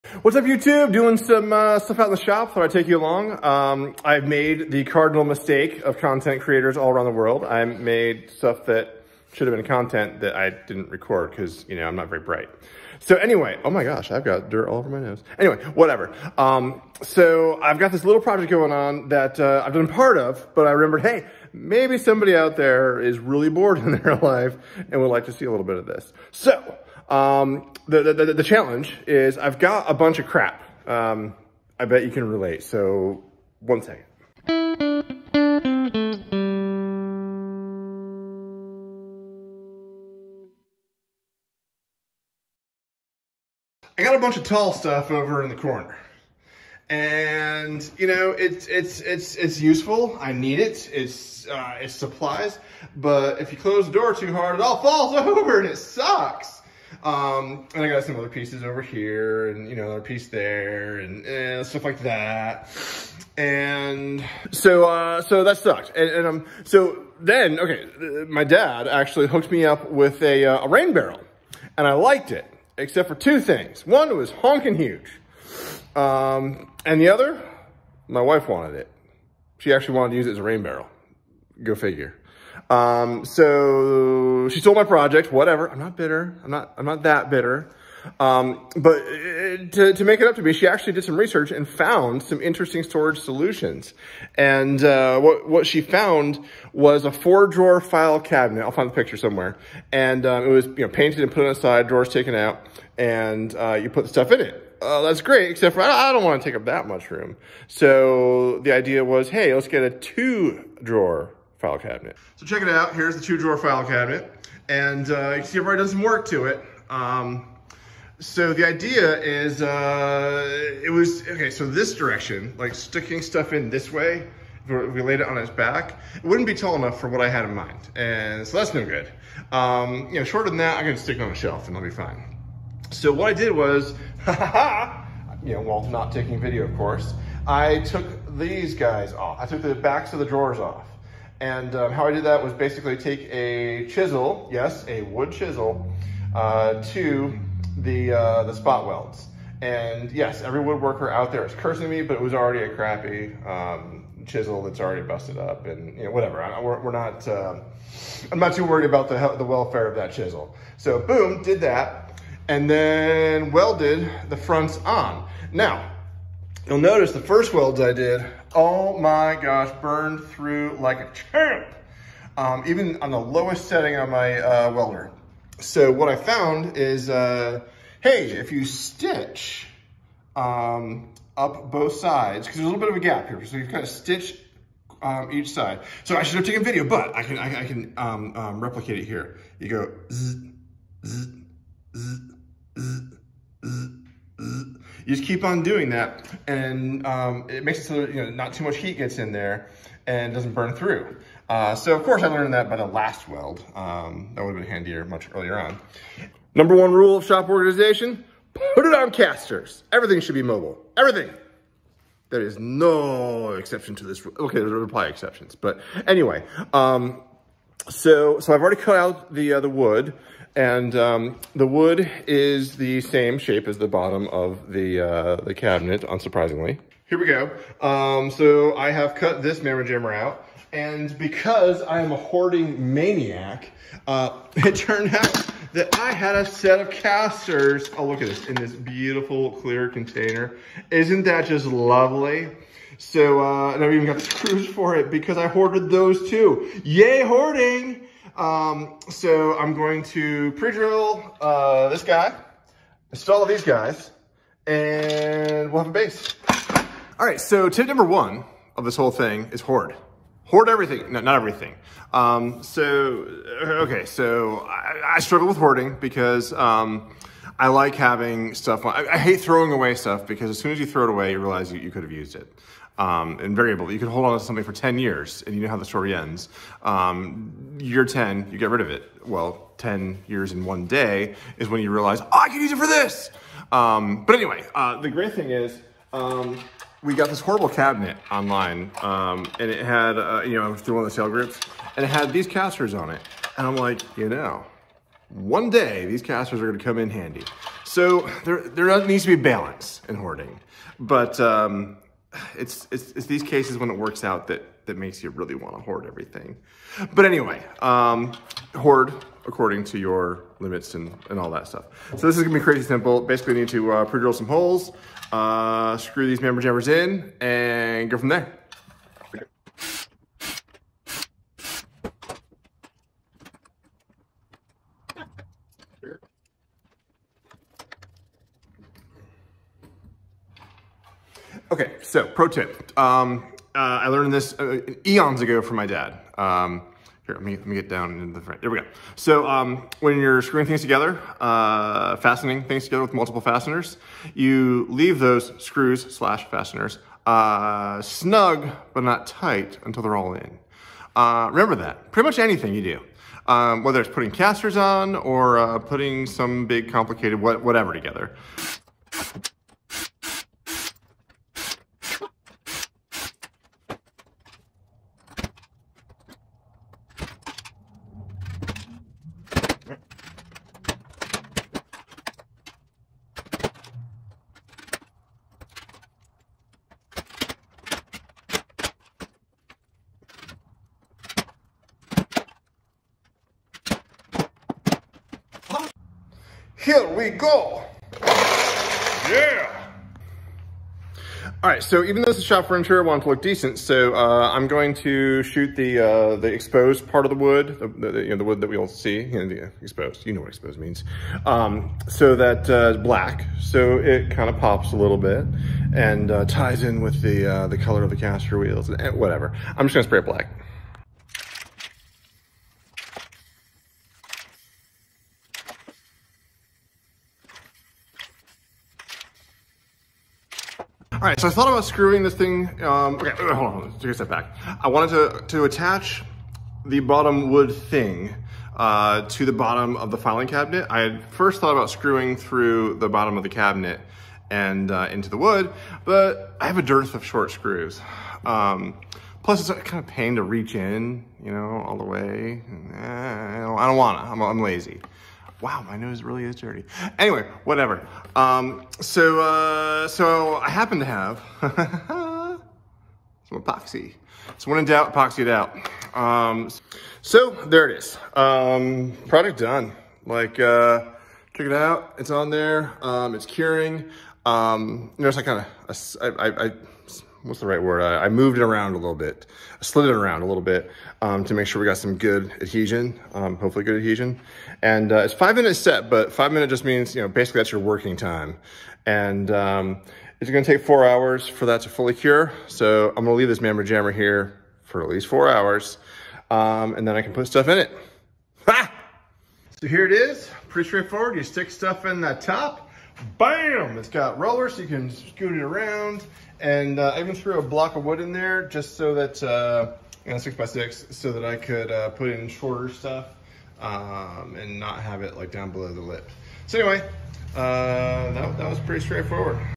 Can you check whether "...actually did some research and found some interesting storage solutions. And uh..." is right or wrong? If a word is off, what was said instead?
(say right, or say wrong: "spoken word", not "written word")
right.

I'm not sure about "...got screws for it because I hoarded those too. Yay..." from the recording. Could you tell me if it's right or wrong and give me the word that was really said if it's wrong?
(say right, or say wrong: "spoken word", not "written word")
right.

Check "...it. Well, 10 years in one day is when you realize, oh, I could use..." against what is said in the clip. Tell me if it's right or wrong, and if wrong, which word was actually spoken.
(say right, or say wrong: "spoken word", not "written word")
right.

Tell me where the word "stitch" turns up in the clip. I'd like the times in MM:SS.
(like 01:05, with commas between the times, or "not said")
02:58, 03:03.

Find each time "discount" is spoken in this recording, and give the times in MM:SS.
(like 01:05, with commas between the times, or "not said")
not said.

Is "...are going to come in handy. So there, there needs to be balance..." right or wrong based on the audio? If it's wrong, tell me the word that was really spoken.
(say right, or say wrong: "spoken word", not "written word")
right.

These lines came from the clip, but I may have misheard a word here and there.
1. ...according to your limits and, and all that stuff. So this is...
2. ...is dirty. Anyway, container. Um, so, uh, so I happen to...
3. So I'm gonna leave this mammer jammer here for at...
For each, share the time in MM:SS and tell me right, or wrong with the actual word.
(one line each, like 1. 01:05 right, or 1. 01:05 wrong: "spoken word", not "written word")
1. 05:09 right
2. 07:26 wrong: "whatever", not "container"
3. 08:02 right.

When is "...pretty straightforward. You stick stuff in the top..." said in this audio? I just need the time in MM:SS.
08:10.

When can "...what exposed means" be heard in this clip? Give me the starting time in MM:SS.
06:40.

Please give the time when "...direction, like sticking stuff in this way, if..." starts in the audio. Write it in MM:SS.
02:01.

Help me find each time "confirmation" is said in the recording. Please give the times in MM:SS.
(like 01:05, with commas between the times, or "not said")
not said.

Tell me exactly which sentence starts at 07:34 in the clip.
So when in doubt, epoxy it out.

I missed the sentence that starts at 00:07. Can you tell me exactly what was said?
I made stuff that should have been content that I didn't record because, you know, I'm not very bright.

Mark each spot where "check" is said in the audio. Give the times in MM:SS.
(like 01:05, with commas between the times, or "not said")
01:52, 07:41.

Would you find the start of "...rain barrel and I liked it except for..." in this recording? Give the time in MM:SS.
01:10.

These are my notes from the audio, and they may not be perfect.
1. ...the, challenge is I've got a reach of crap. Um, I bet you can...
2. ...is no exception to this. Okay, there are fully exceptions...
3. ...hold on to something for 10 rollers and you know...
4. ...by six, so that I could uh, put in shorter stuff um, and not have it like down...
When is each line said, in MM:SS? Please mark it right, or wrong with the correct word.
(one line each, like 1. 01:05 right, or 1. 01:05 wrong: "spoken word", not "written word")
1. 00:28 wrong: "bunch", not "reach"
2. 03:32 wrong: "probably", not "fully"
3. 04:34 wrong: "years", not "rollers"
4. 08:20 right.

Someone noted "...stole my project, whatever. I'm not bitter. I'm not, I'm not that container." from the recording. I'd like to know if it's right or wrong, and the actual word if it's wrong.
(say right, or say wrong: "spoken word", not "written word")
wrong: "bitter", not "container".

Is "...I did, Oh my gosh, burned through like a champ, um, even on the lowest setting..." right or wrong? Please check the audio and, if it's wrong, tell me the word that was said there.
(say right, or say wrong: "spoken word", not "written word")
right.